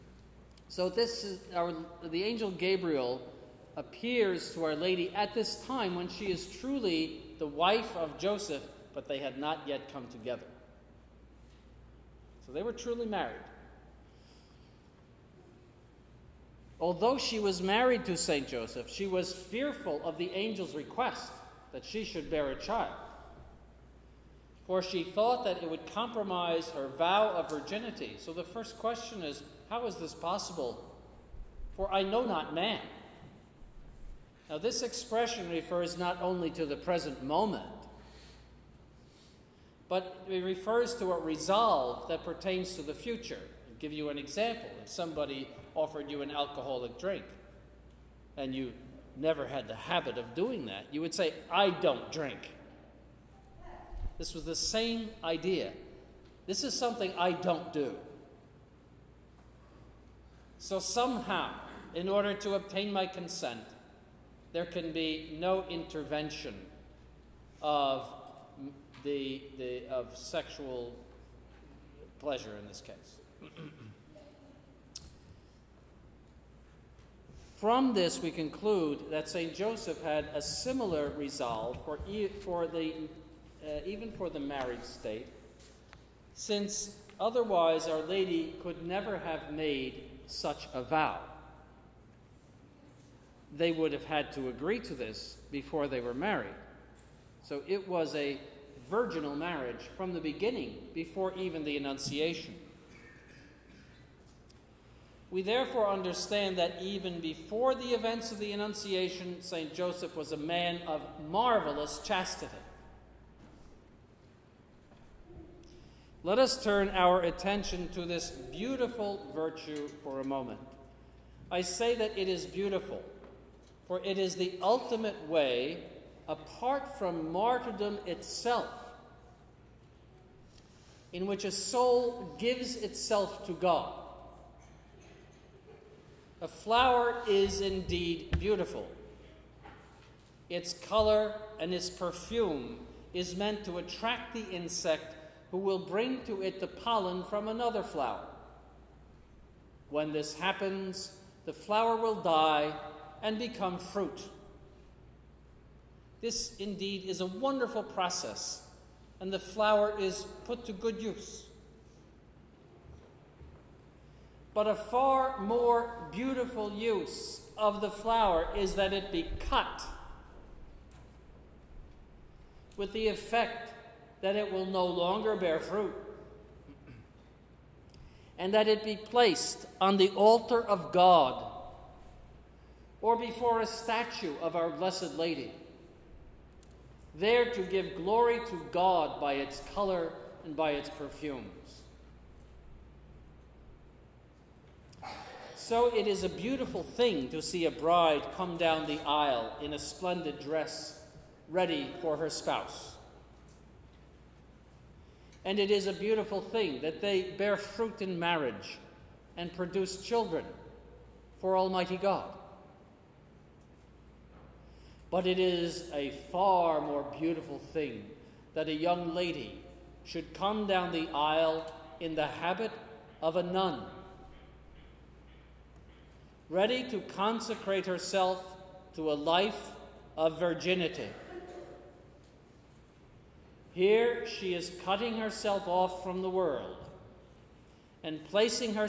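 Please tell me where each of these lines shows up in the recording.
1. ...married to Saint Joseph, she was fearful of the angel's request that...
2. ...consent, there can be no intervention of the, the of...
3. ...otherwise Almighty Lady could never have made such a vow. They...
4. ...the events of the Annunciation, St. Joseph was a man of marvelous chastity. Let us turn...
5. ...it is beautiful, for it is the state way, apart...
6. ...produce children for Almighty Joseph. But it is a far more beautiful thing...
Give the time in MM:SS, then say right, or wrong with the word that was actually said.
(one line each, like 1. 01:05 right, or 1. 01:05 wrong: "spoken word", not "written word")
1. 00:17 right
2. 01:03 right
3. 01:27 wrong: "Our", not "Almighty"
4. 01:47 right
5. 02:02 wrong: "ultimate", not "state"
6. 03:29 wrong: "God", not "Joseph".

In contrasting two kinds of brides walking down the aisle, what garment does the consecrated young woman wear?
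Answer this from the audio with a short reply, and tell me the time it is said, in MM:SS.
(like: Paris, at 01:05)
The habit of a nun, at 03:42.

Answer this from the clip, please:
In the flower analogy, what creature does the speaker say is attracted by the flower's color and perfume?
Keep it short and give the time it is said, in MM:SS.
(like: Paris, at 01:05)
The insect, at 02:24.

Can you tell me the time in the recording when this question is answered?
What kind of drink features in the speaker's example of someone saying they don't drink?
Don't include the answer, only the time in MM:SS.
00:46.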